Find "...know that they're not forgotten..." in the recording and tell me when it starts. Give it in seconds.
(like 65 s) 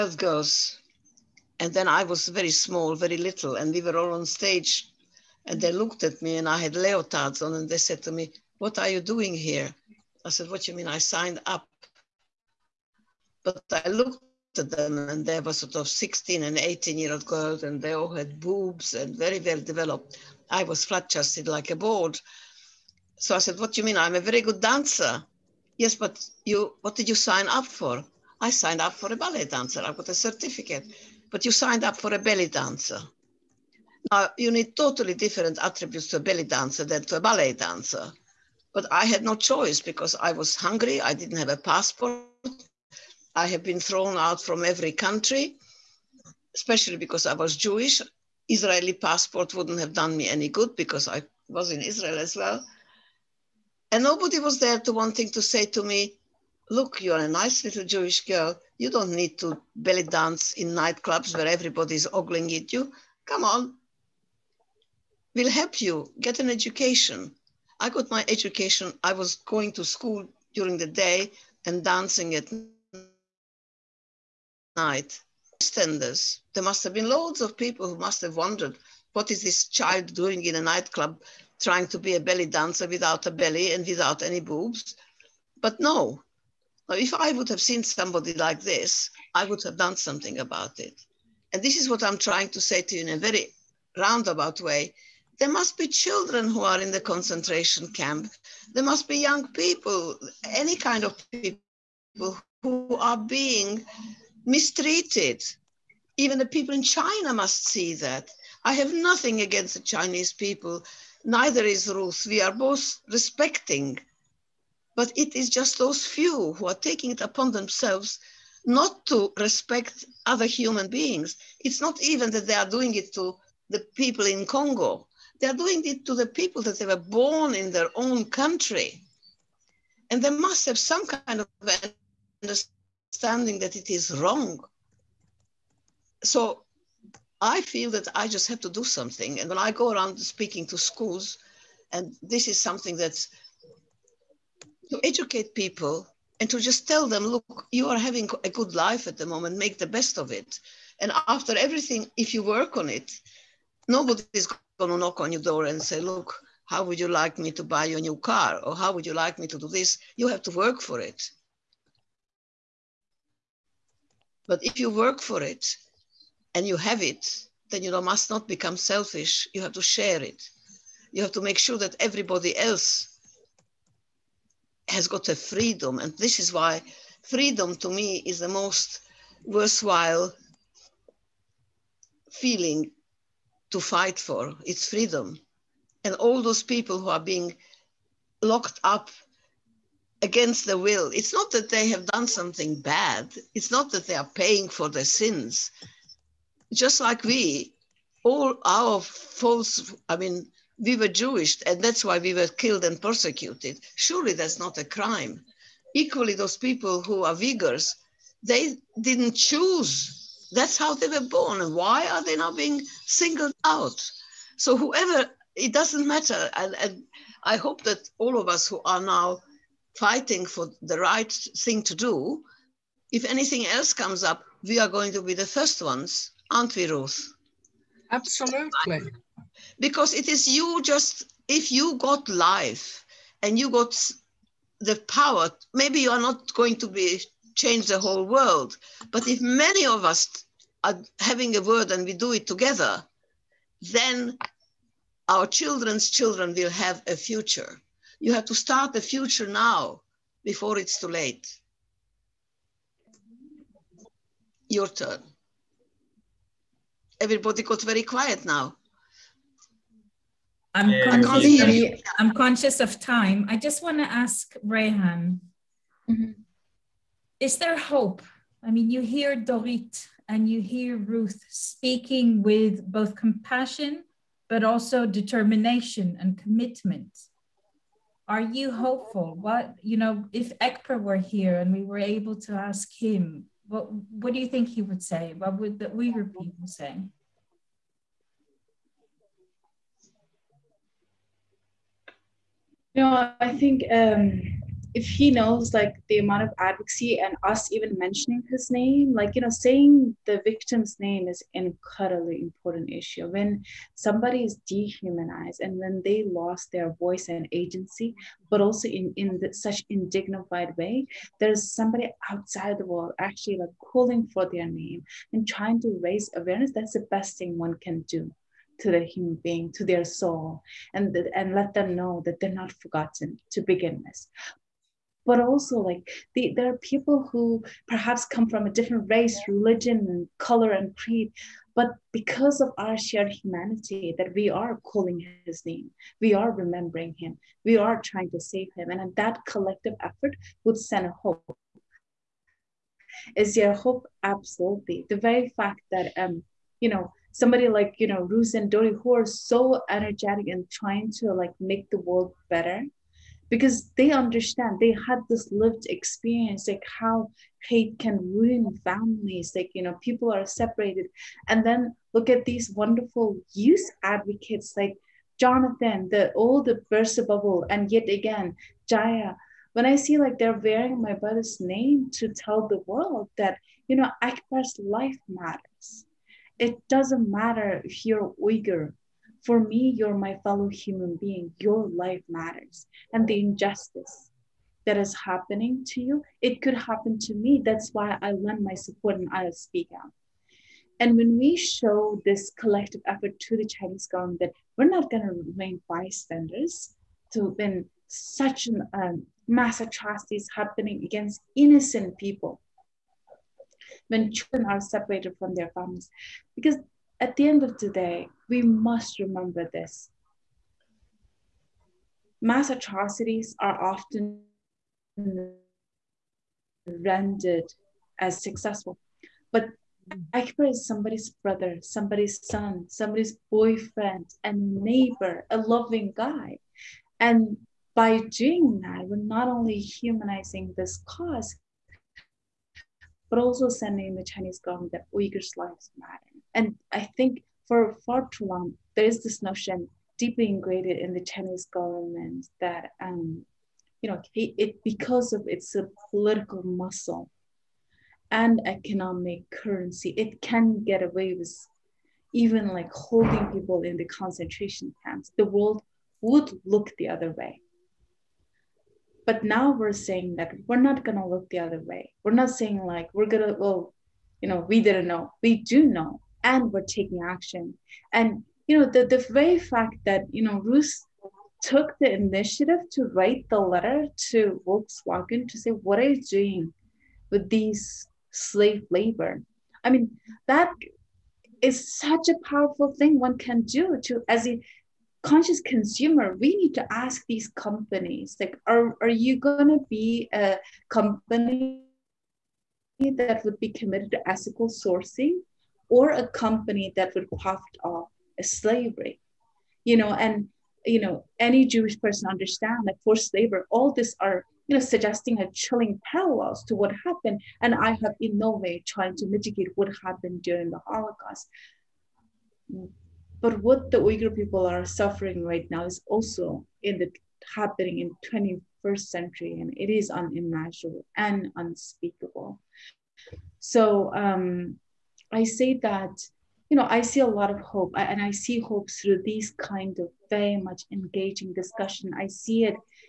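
321 s.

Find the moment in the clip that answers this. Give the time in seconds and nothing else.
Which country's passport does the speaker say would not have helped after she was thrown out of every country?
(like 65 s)
48 s.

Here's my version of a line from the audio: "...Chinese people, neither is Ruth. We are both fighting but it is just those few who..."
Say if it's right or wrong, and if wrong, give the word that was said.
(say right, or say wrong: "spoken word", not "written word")
wrong: "respecting", not "fighting".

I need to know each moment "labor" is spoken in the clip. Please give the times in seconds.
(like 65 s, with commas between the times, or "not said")
478 s, 503 s.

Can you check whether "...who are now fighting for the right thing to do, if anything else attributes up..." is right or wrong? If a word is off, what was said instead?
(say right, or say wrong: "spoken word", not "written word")
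wrong: "comes", not "attributes".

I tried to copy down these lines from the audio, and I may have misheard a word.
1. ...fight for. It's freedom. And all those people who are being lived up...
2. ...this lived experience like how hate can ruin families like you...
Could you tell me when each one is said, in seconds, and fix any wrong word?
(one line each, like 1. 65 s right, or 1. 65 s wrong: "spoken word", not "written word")
1. 183 s wrong: "locked", not "lived"
2. 355 s right.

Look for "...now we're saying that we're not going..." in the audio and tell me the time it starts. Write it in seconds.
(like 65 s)
459 s.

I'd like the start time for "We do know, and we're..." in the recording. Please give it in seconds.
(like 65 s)
465 s.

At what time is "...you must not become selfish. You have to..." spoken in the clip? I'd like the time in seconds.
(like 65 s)
167 s.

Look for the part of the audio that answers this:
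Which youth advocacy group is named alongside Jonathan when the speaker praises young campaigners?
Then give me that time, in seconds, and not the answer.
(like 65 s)
366 s.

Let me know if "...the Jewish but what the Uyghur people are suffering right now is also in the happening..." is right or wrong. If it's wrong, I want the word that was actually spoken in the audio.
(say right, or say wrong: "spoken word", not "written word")
wrong: "Holocaust", not "Jewish".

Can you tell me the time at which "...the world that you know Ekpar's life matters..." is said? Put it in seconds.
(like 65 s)
372 s.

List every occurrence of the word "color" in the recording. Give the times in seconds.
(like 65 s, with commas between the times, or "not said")
330 s.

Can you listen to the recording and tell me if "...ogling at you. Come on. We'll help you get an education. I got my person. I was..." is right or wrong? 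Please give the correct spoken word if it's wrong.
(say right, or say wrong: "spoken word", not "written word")
wrong: "education", not "person".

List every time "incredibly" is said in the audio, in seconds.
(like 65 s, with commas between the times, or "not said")
301 s.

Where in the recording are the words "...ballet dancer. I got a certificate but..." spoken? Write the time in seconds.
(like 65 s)
29 s.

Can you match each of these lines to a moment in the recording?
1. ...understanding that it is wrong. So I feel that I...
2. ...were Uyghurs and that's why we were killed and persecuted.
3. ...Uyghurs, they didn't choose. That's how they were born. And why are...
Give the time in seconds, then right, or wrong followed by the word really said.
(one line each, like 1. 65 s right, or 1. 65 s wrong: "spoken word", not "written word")
1. 132 s right
2. 200 s wrong: "Jewish", not "Uyghurs"
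3. 207 s right.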